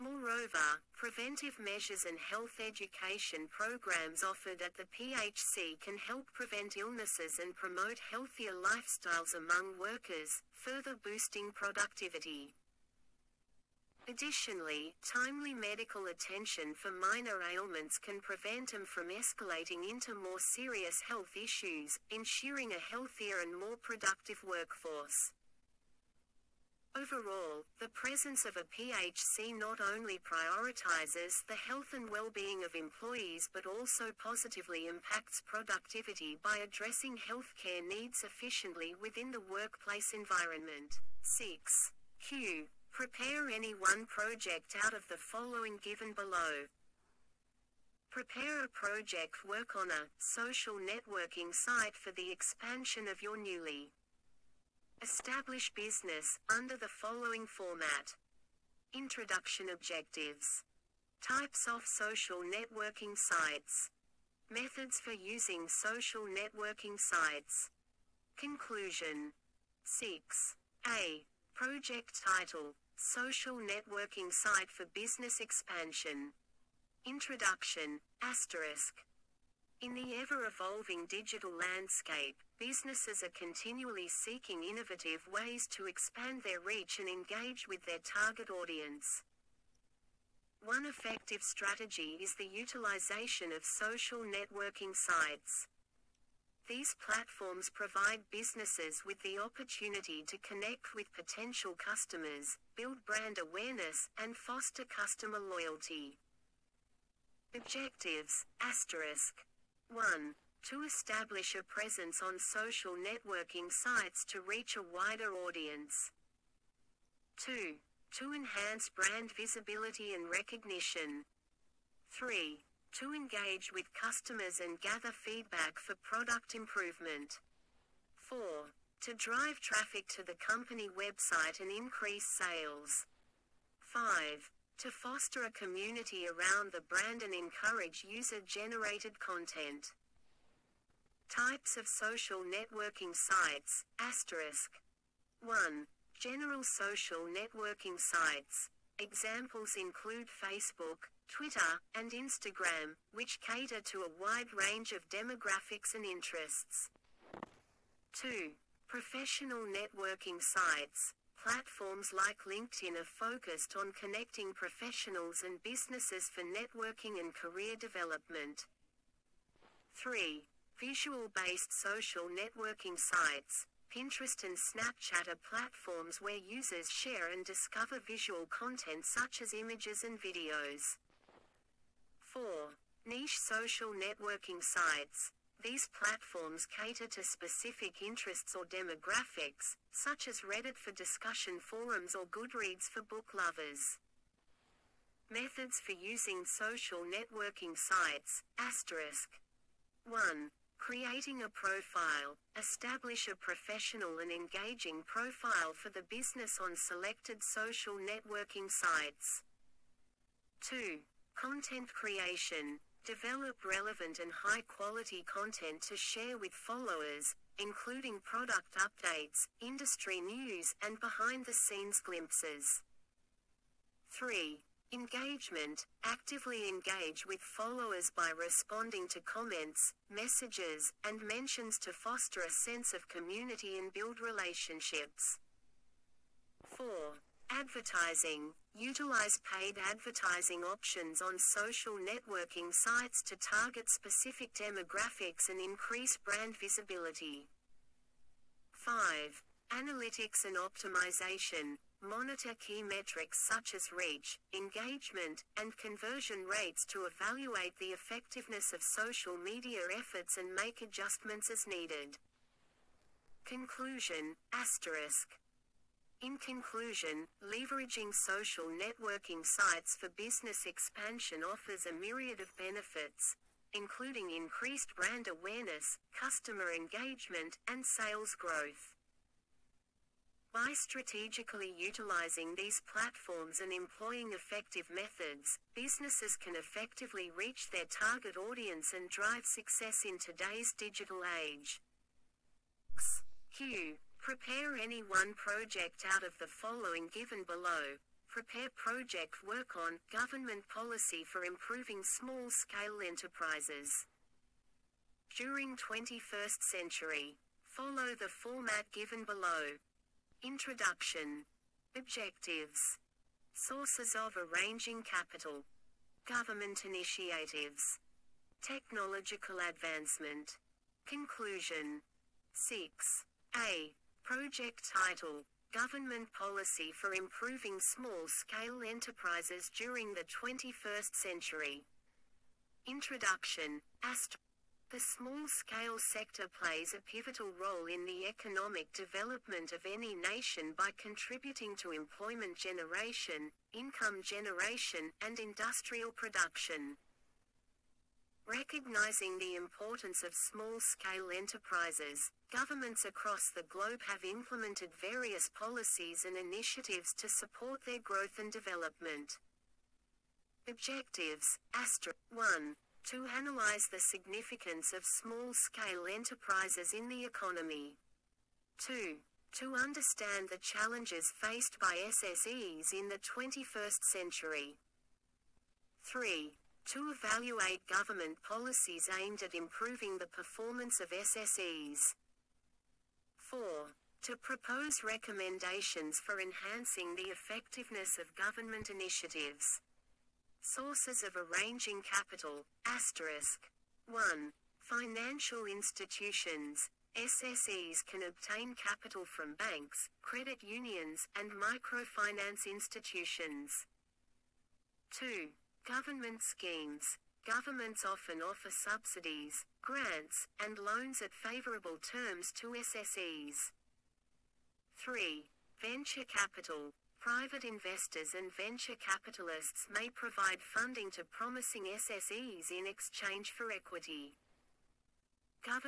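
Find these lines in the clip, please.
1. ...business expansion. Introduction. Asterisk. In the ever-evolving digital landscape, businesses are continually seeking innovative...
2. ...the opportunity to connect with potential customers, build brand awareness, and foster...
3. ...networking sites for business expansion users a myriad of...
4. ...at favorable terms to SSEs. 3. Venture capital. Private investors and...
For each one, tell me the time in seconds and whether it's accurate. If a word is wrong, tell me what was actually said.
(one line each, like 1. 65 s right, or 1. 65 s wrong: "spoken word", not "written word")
1. 74 s right
2. 99 s right
3. 268 s wrong: "offers", not "users"
4. 411 s right.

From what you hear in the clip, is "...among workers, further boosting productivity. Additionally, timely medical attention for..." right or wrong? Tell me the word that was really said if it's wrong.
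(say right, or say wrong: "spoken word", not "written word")
right.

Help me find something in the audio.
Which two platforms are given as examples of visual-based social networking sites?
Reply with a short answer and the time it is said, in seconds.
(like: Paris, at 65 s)
Pinterest and Snapchat, at 173 s.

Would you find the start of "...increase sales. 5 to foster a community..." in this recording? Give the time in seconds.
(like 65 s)
131 s.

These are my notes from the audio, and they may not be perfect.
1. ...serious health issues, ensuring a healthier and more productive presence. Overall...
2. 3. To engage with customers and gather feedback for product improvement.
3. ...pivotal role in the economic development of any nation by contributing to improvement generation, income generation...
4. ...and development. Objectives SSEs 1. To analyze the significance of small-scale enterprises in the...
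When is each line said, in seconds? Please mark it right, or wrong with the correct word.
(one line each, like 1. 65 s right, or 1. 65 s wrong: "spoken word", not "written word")
1. 20 s wrong: "workforce", not "presence"
2. 122 s right
3. 337 s wrong: "employment", not "improvement"
4. 358 s wrong: "Astra", not "SSEs".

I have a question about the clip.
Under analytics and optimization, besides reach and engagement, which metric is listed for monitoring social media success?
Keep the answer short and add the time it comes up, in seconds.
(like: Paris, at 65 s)
conversion rates, at 255 s.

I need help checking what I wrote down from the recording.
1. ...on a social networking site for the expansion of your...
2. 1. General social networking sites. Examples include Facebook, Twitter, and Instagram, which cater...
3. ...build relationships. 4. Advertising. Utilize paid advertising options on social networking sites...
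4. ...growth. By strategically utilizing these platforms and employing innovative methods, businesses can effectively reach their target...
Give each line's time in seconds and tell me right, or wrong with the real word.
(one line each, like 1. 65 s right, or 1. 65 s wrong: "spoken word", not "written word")
1. 49 s right
2. 145 s right
3. 233 s right
4. 278 s wrong: "effective", not "innovative".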